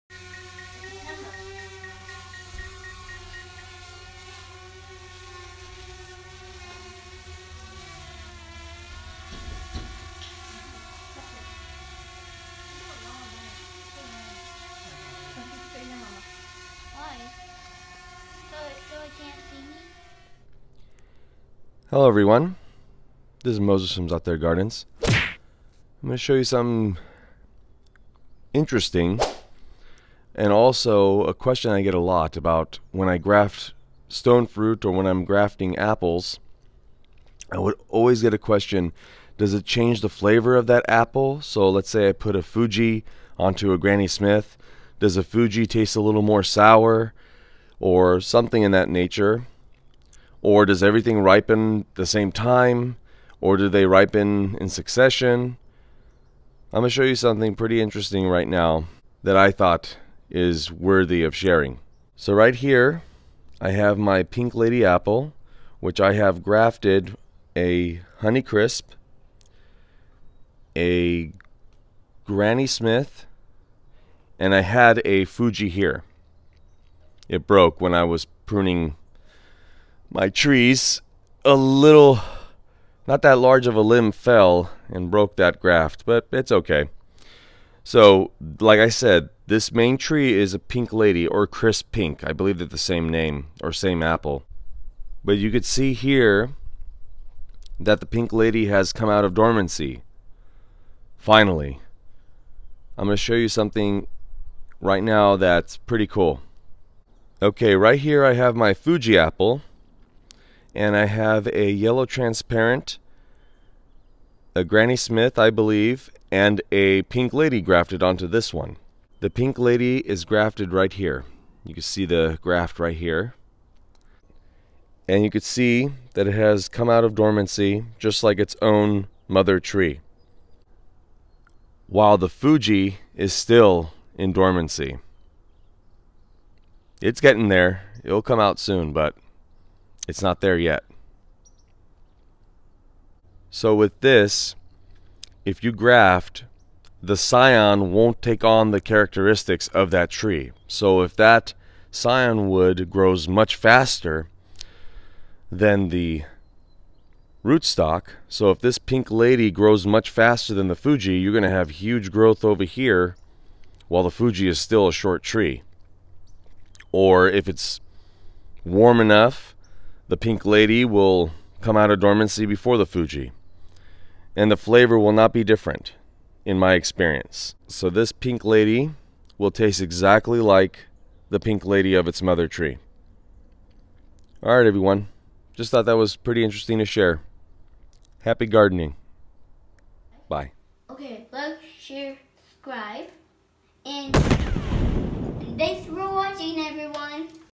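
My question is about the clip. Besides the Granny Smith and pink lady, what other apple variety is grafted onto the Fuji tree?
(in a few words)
Yellow transparent.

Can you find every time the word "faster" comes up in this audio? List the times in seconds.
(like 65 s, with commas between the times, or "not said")
153 s, 160 s.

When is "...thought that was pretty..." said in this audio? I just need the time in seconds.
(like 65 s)
185 s.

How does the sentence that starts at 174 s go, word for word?
And the flavor will not be different in my experience.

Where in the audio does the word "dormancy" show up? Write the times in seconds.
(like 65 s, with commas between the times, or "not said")
99 s, 127 s, 134 s, 171 s.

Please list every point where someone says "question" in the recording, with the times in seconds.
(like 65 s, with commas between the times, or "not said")
31 s, 38 s.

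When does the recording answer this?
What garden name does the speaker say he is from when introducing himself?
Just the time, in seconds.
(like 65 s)
24 s.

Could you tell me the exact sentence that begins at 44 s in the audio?
Does a Fuji taste a little more sour?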